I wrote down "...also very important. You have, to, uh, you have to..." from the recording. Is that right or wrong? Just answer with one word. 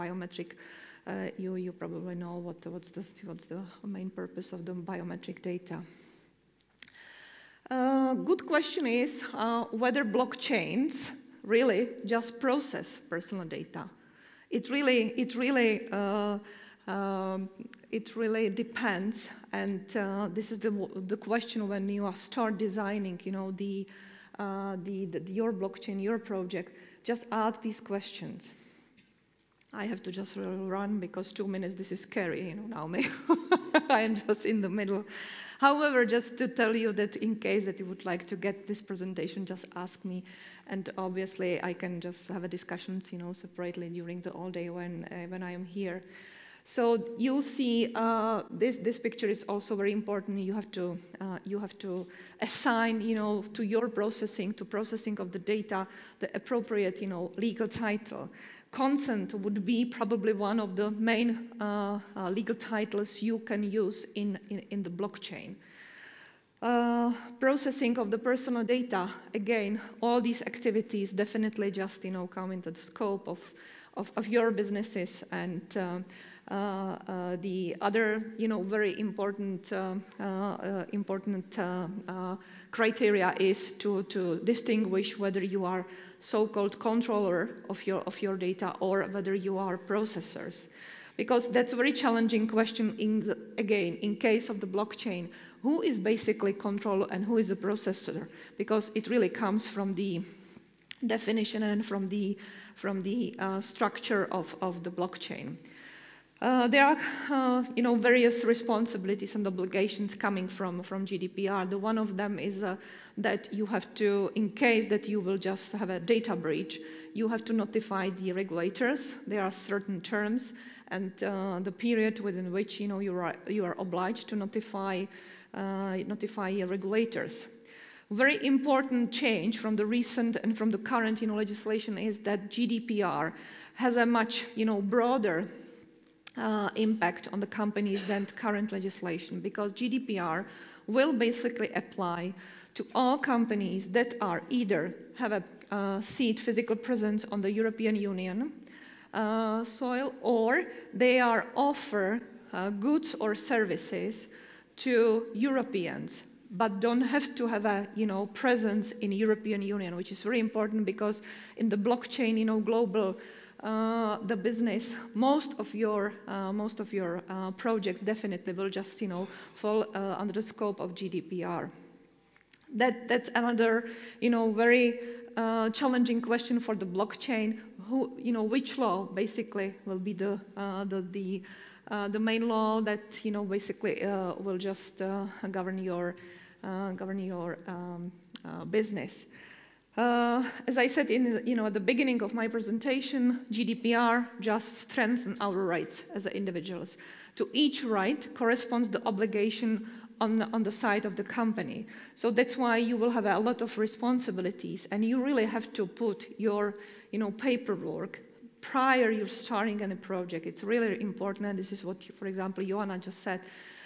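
right.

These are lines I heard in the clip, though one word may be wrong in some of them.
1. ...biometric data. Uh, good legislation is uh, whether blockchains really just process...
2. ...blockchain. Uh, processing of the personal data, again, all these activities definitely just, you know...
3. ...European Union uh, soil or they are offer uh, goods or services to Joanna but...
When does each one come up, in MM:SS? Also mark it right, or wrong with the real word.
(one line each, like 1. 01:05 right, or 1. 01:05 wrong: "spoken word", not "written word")
1. 00:04 wrong: "question", not "legislation"
2. 01:04 right
3. 02:27 wrong: "Europeans", not "Joanna".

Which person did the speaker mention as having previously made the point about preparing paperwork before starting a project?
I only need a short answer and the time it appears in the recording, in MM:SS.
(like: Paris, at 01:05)
Joanna, at 03:32.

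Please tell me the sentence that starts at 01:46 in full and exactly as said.
Uh, there are, uh, you know, various responsibilities and obligations coming from, from GDPR.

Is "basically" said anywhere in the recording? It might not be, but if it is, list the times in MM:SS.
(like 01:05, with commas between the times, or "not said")
01:35, 02:21, 02:59, 03:03.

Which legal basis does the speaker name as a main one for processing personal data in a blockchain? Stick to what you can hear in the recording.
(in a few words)
Consent.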